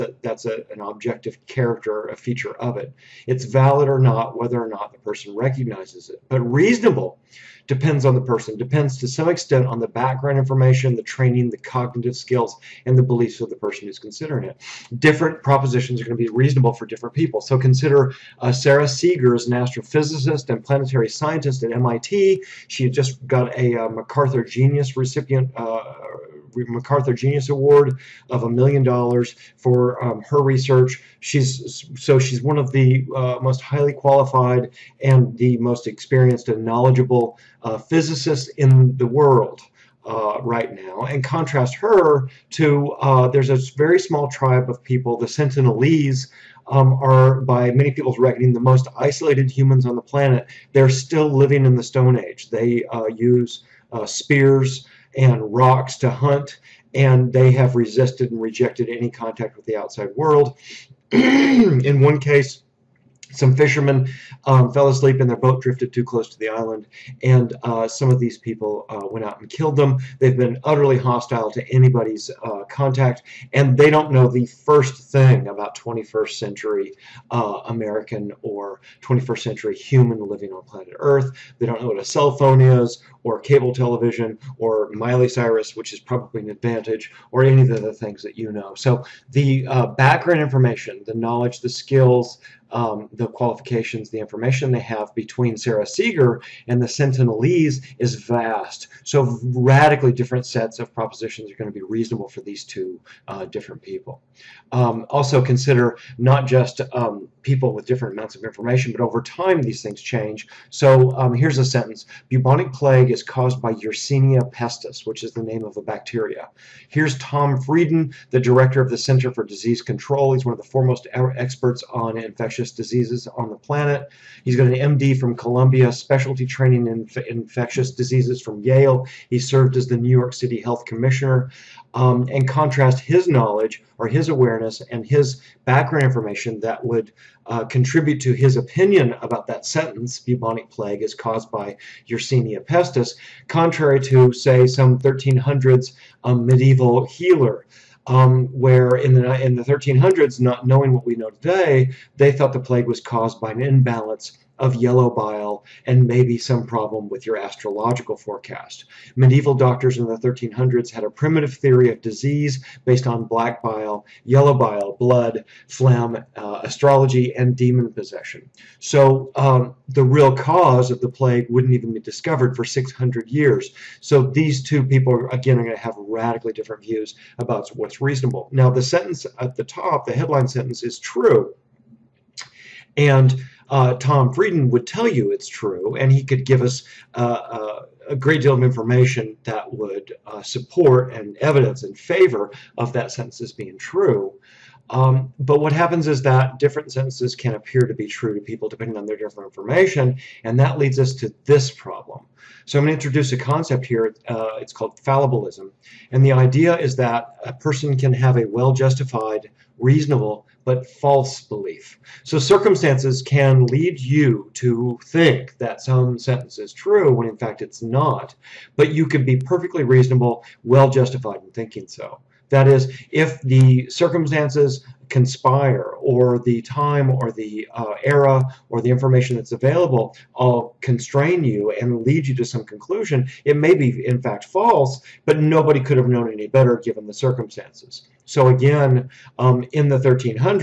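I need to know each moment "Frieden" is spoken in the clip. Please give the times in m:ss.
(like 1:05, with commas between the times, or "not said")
1:57, 3:04.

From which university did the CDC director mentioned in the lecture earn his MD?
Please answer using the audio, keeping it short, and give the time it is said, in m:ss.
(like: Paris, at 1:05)
Columbia, at 2:05.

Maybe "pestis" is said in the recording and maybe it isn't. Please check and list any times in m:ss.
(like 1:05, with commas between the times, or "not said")
1:54, 2:22.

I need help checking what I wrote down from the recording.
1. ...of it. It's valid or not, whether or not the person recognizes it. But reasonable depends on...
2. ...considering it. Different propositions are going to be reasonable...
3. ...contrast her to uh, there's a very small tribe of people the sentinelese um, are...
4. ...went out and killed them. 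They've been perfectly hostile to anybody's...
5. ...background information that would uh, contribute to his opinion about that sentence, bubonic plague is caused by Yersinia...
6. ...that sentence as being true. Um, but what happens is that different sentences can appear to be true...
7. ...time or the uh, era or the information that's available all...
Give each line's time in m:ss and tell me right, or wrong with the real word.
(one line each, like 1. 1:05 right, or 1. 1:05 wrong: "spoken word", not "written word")
1. 0:02 right
2. 0:13 right
3. 0:41 right
4. 1:09 wrong: "utterly", not "perfectly"
5. 2:15 right
6. 3:12 right
7. 3:46 right.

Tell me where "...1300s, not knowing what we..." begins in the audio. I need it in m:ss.
2:29.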